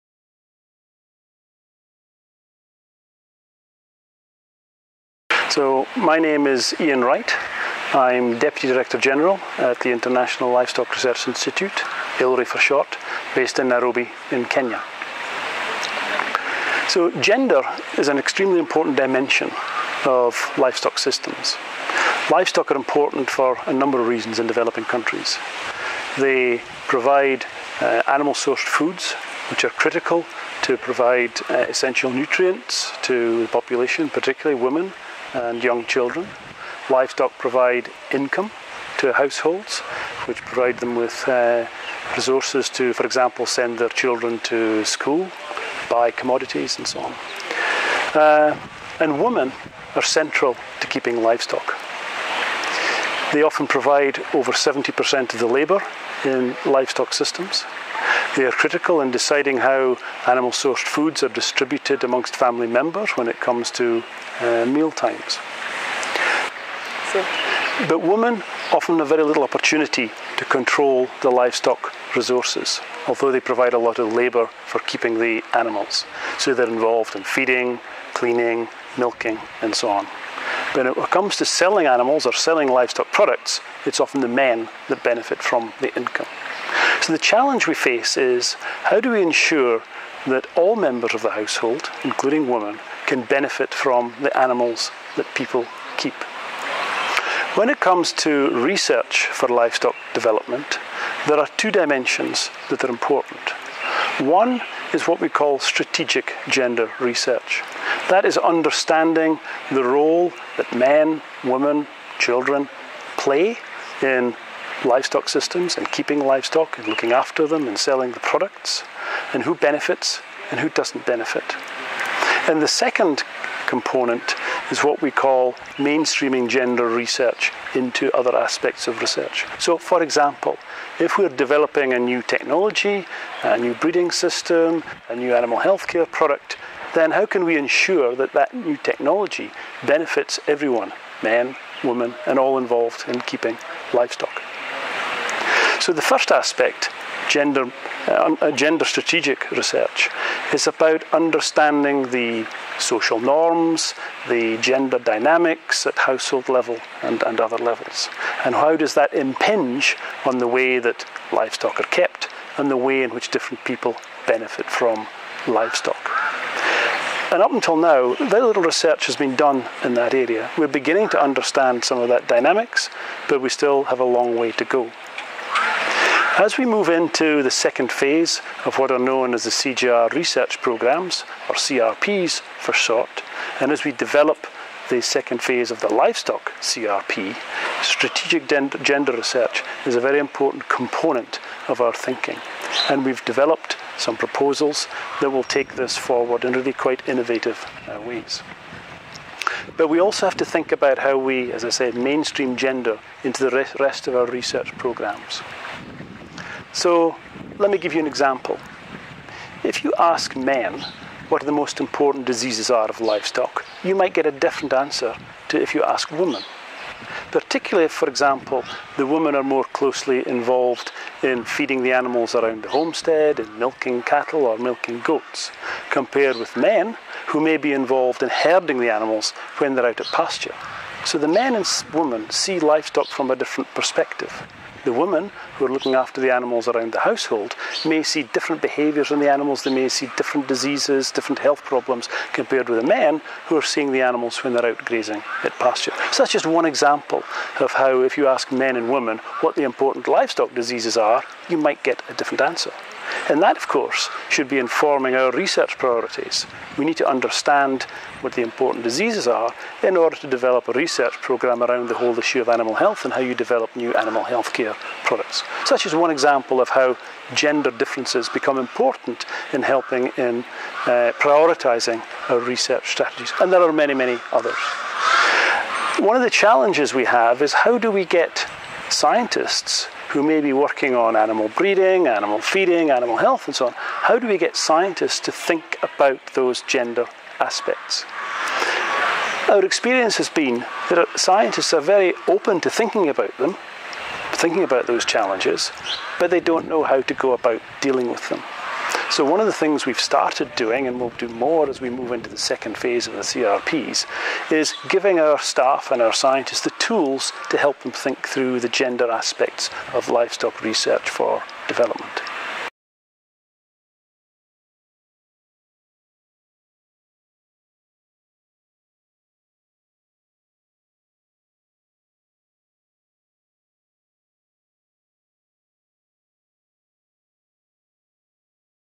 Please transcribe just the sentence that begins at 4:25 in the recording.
Such is one example of how gender differences become important in helping in uh, prioritising our research strategies.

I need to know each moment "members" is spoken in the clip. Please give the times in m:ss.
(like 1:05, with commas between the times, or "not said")
1:02, 1:30.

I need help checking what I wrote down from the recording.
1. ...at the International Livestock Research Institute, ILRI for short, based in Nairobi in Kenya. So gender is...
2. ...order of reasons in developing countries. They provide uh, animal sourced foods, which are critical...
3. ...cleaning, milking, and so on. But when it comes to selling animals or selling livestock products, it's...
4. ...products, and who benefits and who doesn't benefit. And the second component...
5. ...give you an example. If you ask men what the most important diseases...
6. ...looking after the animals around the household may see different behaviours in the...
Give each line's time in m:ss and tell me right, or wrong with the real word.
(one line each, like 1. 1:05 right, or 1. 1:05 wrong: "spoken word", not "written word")
1. 0:09 right
2. 0:23 wrong: "number", not "order"
3. 1:18 right
4. 1:58 right
5. 3:27 right
6. 3:55 right.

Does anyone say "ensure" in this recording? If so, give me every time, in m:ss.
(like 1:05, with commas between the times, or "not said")
1:29, 2:17.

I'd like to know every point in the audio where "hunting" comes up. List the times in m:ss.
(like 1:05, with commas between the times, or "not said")
not said.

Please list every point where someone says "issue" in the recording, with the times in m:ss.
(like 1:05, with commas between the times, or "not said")
4:22.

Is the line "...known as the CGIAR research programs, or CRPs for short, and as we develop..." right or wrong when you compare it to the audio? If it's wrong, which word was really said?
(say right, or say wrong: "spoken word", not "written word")
right.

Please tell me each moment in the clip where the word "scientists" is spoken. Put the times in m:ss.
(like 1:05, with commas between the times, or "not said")
4:38, 4:44, 4:51, 5:06.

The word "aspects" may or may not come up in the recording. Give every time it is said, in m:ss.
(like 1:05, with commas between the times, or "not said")
2:08, 2:26, 4:47, 5:09.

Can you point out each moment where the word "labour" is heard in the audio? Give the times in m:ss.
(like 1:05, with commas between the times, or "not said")
0:55, 1:14.